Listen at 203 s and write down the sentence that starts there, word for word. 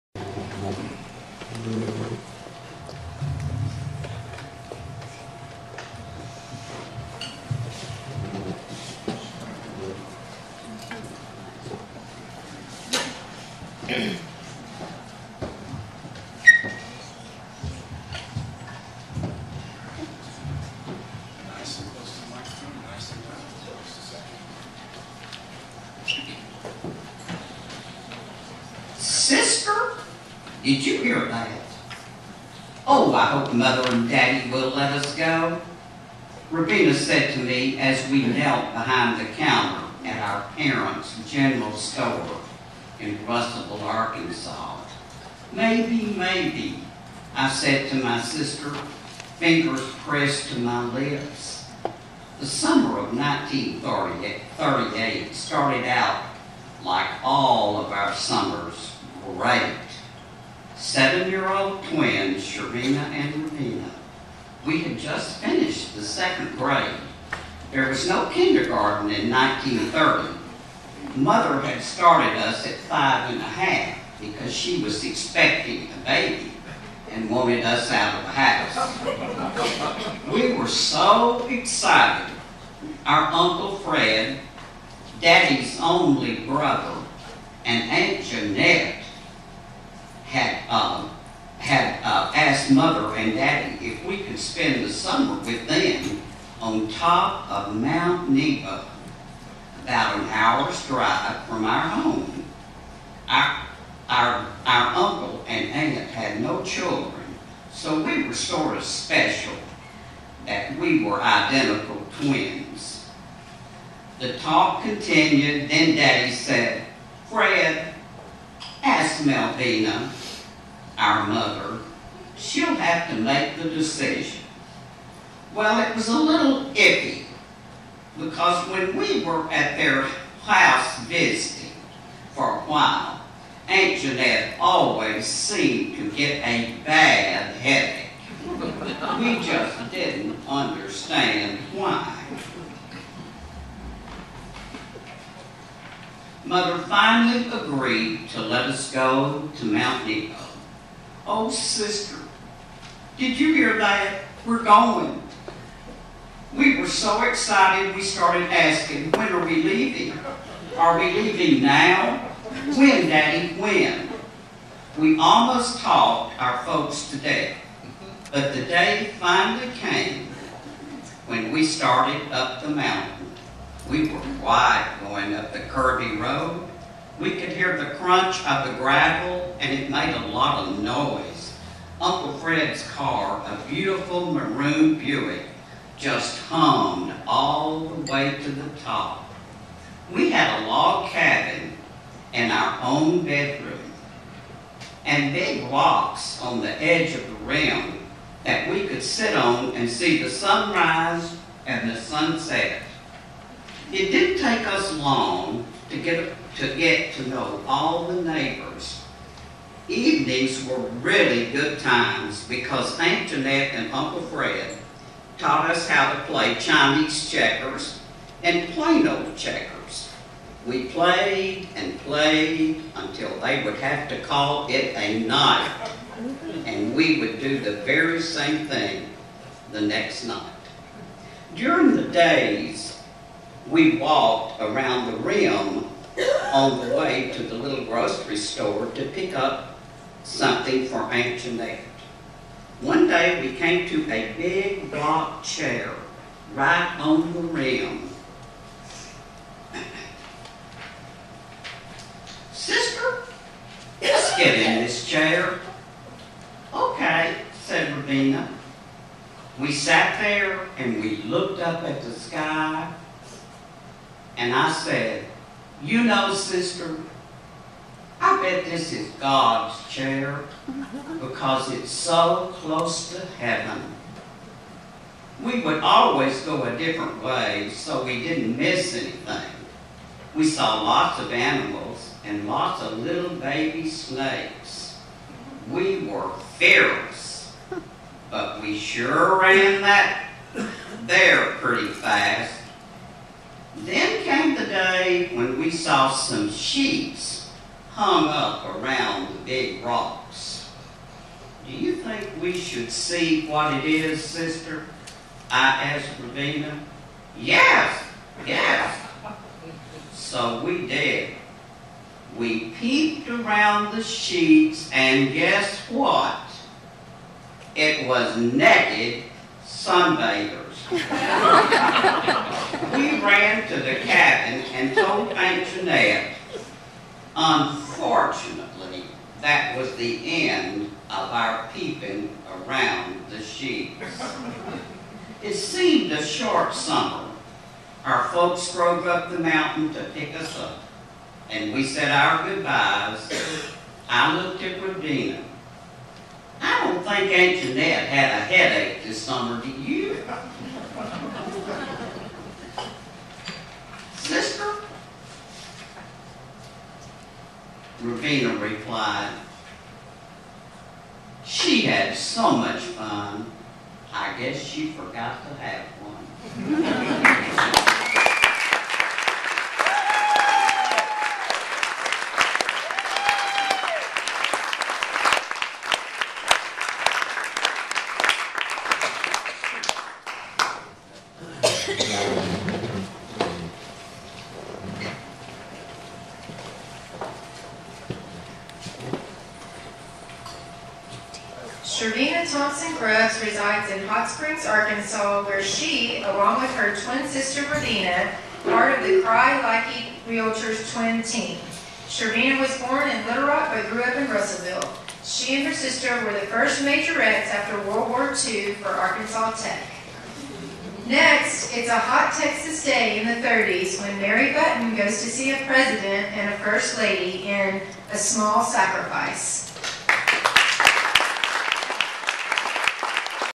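It didn't take us long to get to get to know all the neighbors.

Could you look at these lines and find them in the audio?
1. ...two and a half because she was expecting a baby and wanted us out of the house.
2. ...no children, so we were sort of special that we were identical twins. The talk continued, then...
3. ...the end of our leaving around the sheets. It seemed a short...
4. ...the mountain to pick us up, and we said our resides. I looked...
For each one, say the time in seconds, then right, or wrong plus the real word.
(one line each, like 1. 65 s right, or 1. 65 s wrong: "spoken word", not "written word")
1. 72 s wrong: "five", not "two"
2. 106 s right
3. 329 s wrong: "peeping", not "leaving"
4. 339 s wrong: "goodbyes", not "resides".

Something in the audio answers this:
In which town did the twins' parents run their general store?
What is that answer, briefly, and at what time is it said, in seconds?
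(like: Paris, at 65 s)
Russellville, Arkansas, at 43 s.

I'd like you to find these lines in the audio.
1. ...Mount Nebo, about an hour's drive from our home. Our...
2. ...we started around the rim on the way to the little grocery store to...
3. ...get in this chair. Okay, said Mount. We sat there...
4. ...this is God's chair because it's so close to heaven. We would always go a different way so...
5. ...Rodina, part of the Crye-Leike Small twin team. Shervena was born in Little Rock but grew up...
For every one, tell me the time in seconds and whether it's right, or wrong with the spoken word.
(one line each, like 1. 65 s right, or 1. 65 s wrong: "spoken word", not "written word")
1. 97 s right
2. 233 s wrong: "walked", not "started"
3. 254 s wrong: "Ravina", not "Mount"
4. 268 s right
5. 397 s wrong: "Realtors", not "Small".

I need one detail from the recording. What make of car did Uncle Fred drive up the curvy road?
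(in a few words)
Buick.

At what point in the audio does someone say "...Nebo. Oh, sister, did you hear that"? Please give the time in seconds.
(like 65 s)
150 s.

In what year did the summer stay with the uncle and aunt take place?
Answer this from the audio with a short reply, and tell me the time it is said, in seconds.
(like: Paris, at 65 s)
1938, at 53 s.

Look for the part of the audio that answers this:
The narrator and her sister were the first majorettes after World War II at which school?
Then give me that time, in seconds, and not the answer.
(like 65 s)
408 s.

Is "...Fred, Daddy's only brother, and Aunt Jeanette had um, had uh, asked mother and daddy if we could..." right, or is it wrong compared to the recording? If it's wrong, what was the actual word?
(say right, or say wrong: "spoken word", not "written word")
right.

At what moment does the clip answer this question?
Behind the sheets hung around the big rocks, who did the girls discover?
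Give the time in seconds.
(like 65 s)
318 s.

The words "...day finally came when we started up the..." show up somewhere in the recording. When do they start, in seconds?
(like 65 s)
168 s.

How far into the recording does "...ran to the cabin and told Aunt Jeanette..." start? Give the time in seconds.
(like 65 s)
323 s.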